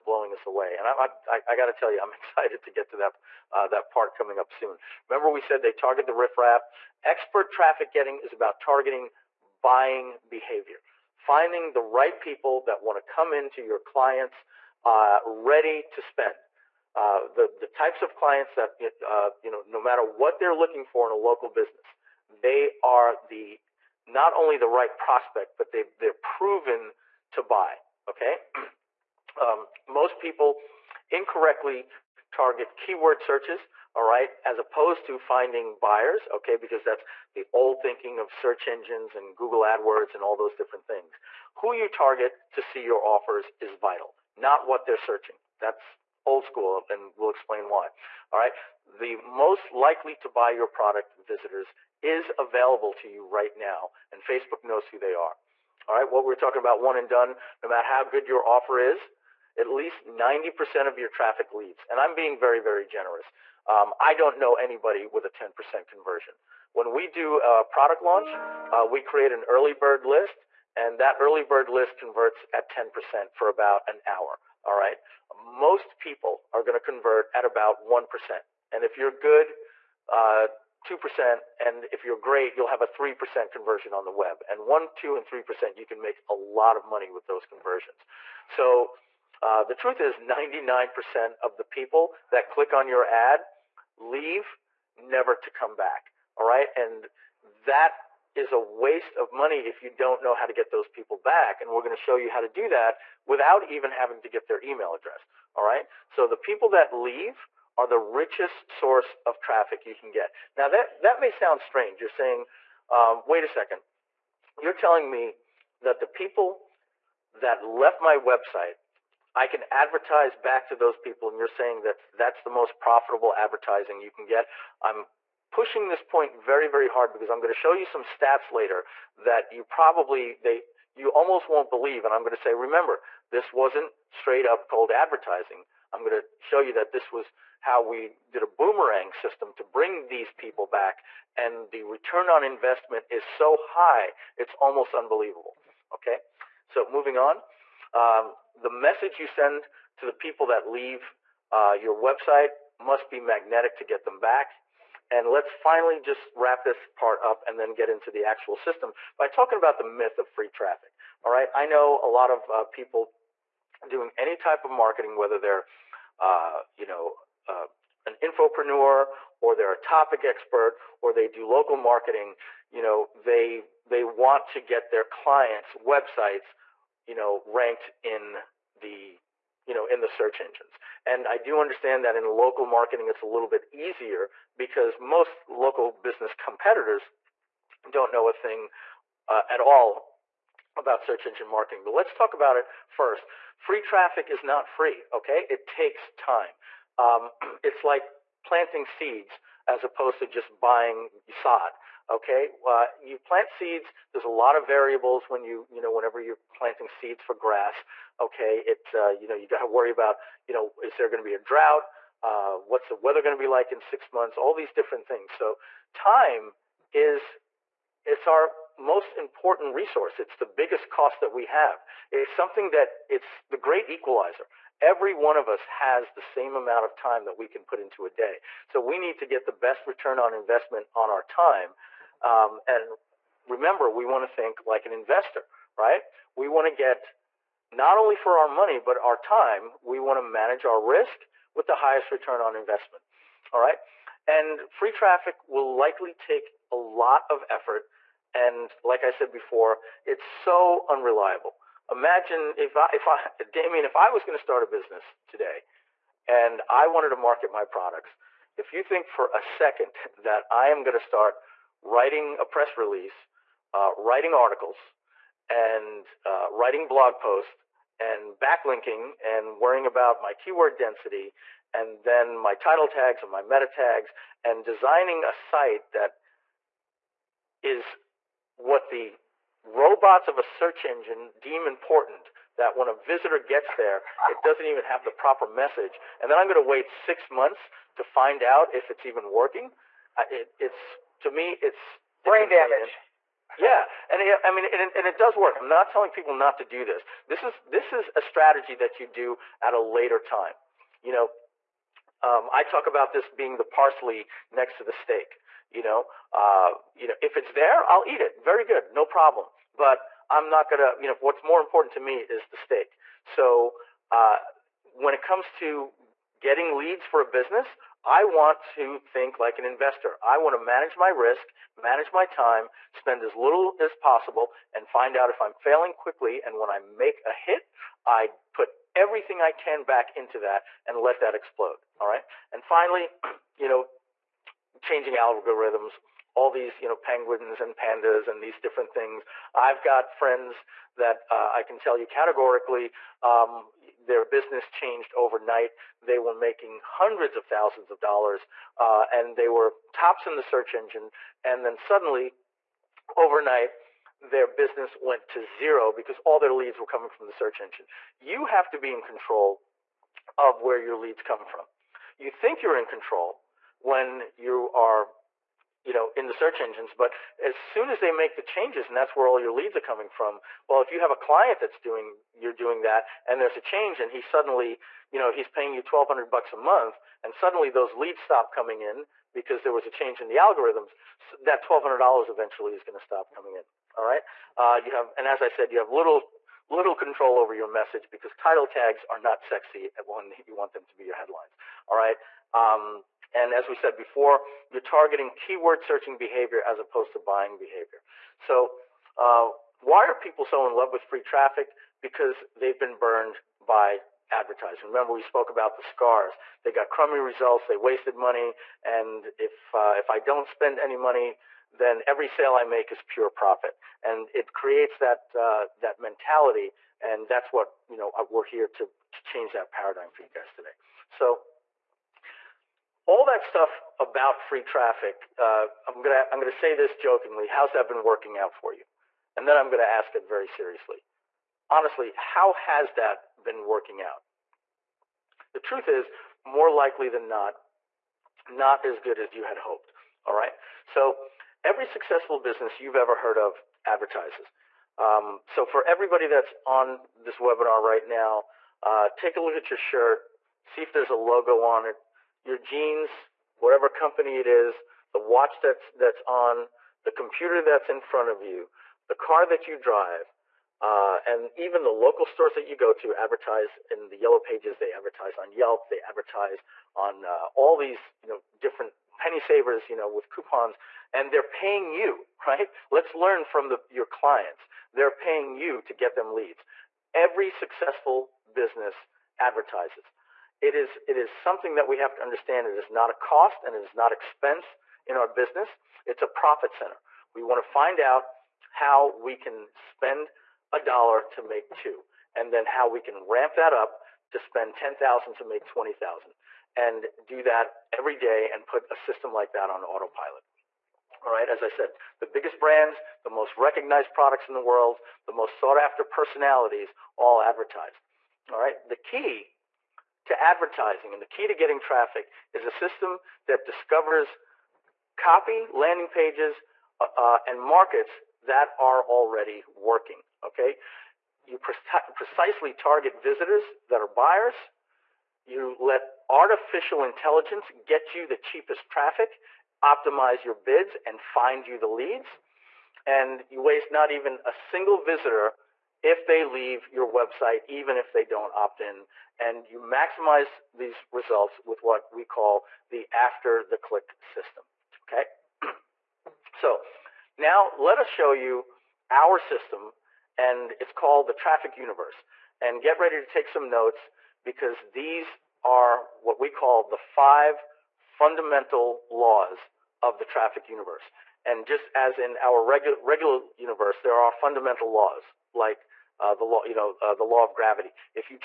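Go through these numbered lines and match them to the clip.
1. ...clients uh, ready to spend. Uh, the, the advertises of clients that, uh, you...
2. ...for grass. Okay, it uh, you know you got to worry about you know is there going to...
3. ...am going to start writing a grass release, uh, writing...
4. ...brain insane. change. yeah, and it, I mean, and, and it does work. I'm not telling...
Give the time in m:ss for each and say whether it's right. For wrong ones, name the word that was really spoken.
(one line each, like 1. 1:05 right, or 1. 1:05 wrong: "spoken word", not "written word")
1. 0:13 wrong: "types", not "advertises"
2. 3:27 right
3. 4:20 wrong: "press", not "grass"
4. 4:52 wrong: "damage", not "change".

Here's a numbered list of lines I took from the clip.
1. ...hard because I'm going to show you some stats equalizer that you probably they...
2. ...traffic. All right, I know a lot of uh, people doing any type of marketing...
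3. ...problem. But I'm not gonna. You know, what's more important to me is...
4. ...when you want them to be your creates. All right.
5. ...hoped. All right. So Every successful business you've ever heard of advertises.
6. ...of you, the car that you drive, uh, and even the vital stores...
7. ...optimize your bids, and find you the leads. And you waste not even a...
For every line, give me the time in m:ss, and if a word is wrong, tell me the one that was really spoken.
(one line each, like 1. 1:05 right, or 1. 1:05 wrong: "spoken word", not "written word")
1. 2:06 wrong: "later", not "equalizer"
2. 2:40 right
3. 5:09 right
4. 6:30 wrong: "headlines", not "creates"
5. 7:19 right
6. 7:38 wrong: "local", not "vital"
7. 8:49 right.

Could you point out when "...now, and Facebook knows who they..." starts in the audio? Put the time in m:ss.
0:53.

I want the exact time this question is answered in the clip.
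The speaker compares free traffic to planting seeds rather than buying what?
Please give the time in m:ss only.
3:21.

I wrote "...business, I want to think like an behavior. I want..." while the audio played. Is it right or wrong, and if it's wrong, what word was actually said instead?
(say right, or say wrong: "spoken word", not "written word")
wrong: "investor", not "behavior".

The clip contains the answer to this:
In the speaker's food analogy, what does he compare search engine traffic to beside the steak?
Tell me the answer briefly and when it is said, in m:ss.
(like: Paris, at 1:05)
parsley, at 5:03.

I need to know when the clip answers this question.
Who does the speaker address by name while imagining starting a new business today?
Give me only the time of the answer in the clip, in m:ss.
4:13.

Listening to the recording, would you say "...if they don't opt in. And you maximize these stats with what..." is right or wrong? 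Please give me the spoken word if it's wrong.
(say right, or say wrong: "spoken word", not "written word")
wrong: "results", not "stats".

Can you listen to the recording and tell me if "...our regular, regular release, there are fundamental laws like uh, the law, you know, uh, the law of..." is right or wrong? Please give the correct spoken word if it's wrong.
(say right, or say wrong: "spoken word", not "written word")
wrong: "universe", not "release".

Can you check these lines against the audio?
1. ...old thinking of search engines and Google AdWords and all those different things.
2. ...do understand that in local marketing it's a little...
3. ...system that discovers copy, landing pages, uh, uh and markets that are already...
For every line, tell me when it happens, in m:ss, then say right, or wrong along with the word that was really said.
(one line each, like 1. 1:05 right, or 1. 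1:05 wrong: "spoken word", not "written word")
1. 0:37 right
2. 3:01 right
3. 8:32 right.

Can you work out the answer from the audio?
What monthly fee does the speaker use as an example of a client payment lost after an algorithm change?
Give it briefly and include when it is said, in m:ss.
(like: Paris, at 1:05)
$1,200, at 6:15.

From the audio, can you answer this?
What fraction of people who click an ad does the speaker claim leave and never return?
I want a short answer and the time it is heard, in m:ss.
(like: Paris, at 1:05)
99%, at 1:30.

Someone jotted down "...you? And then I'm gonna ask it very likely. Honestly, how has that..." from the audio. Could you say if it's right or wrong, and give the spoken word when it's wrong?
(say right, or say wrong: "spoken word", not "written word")
wrong: "seriously", not "likely".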